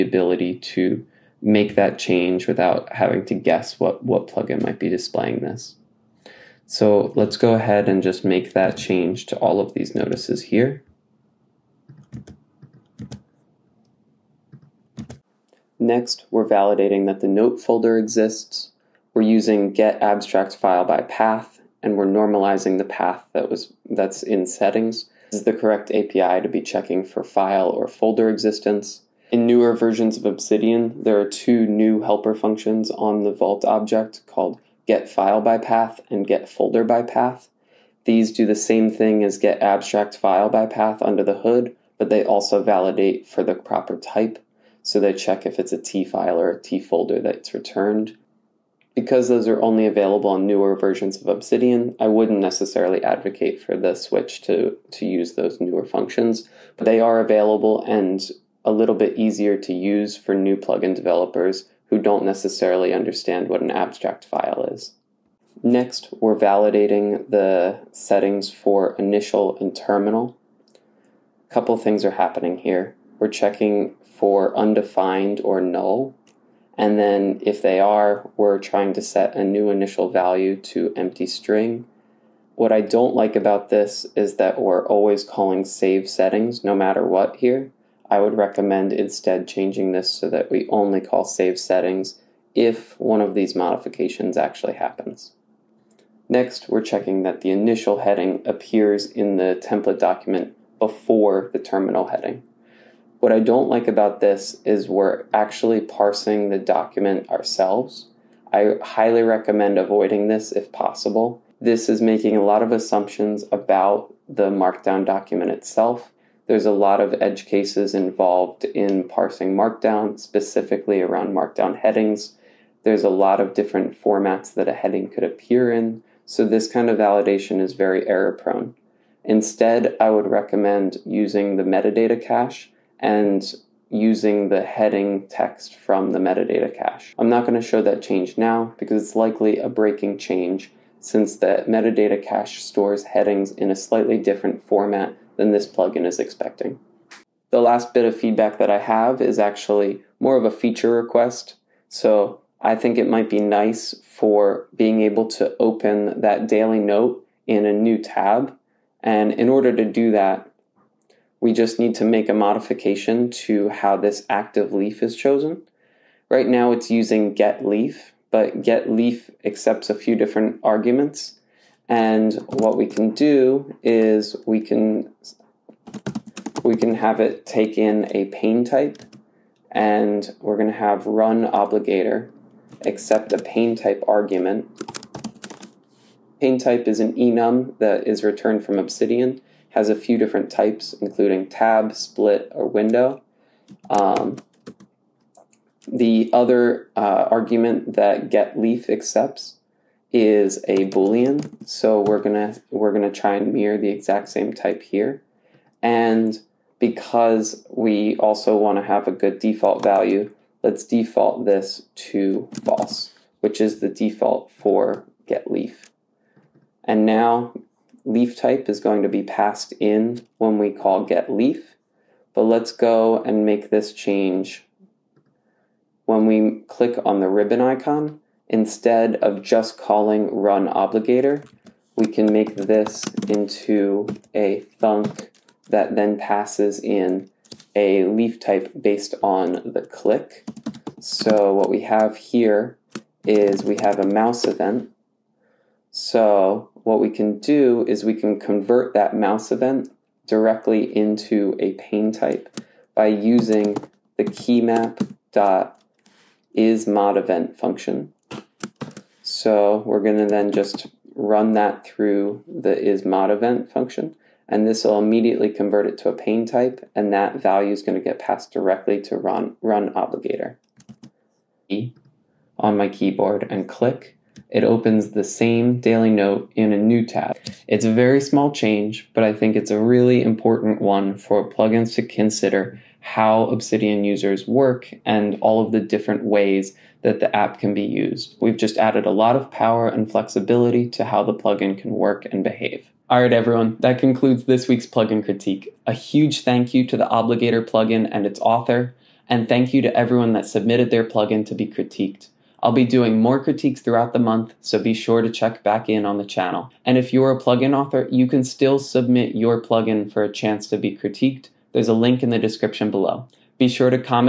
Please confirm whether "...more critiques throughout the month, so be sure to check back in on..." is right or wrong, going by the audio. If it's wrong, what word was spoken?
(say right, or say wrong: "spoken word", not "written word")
right.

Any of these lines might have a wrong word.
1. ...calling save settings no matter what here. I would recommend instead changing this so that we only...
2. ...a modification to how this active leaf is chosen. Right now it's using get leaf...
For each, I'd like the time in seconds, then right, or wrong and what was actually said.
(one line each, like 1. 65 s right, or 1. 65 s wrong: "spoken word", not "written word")
1. 85 s right
2. 162 s right.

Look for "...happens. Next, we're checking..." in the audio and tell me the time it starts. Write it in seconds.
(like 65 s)
94 s.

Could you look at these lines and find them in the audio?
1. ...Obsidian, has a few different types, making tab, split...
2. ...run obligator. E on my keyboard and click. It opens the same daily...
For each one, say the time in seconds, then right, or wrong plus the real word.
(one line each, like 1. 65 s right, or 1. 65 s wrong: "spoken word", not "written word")
1. 188 s wrong: "including", not "making"
2. 269 s right.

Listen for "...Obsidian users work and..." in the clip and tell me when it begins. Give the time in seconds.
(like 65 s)
283 s.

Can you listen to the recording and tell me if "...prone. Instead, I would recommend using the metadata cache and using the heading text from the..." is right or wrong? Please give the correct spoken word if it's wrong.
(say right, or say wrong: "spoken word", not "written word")
right.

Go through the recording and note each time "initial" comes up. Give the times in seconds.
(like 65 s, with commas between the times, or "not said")
68 s, 79 s, 97 s.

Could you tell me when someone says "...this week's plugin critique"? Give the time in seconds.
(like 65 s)
294 s.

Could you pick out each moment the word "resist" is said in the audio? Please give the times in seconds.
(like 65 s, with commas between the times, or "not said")
not said.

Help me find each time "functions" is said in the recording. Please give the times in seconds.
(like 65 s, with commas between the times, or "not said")
32 s, 55 s, 257 s, 263 s.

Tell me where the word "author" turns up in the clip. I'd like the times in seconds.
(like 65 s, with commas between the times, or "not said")
298 s, 307 s.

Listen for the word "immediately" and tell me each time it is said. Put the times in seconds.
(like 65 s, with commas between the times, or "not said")
264 s.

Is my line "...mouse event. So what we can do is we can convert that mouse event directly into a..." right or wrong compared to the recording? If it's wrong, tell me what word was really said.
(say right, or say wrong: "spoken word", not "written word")
right.